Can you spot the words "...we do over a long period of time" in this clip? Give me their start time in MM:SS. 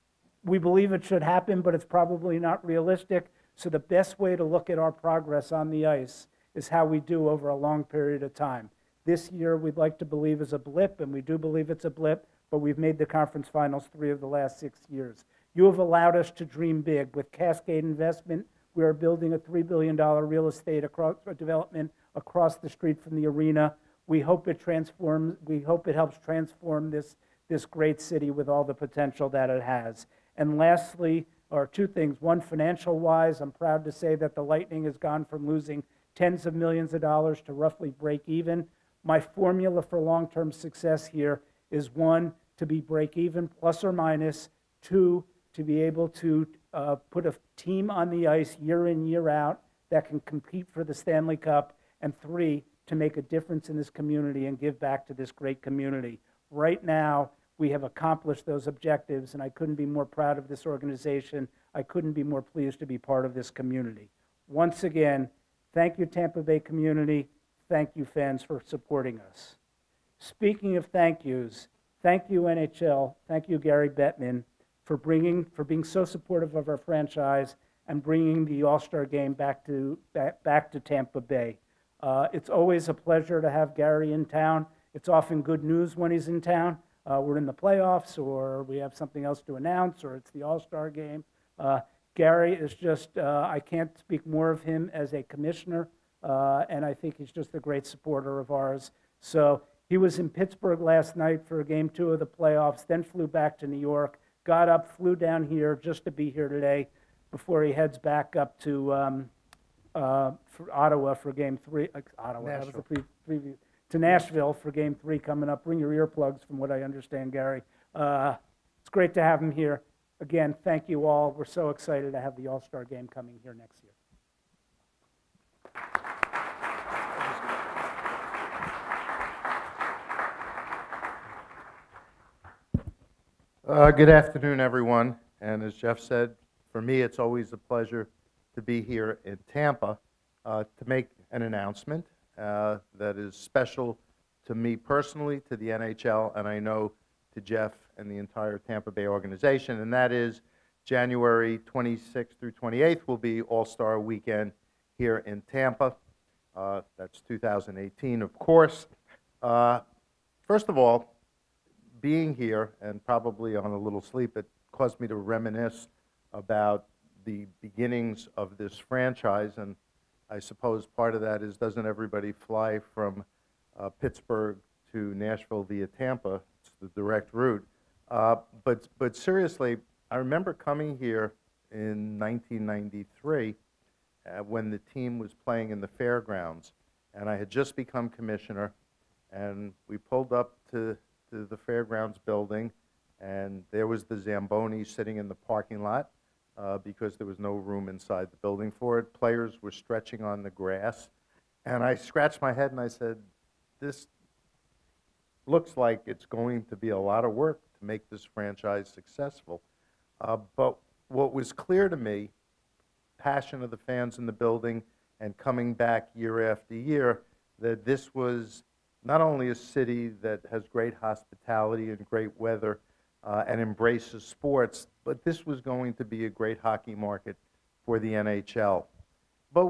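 00:06.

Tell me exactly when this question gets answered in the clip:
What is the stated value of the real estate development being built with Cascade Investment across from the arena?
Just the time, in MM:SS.
00:19.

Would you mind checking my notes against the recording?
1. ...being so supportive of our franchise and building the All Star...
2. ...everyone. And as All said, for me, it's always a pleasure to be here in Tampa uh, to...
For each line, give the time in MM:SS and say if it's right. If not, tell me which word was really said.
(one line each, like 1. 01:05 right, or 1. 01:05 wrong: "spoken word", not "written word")
1. 01:15 wrong: "bringing", not "building"
2. 02:14 wrong: "Jeff", not "All".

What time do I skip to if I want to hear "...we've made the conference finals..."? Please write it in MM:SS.
00:12.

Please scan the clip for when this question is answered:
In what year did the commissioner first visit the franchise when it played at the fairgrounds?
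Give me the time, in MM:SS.
03:02.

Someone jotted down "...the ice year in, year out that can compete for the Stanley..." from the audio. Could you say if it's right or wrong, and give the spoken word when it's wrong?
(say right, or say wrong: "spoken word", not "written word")
right.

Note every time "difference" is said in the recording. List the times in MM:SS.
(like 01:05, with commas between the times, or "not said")
00:53.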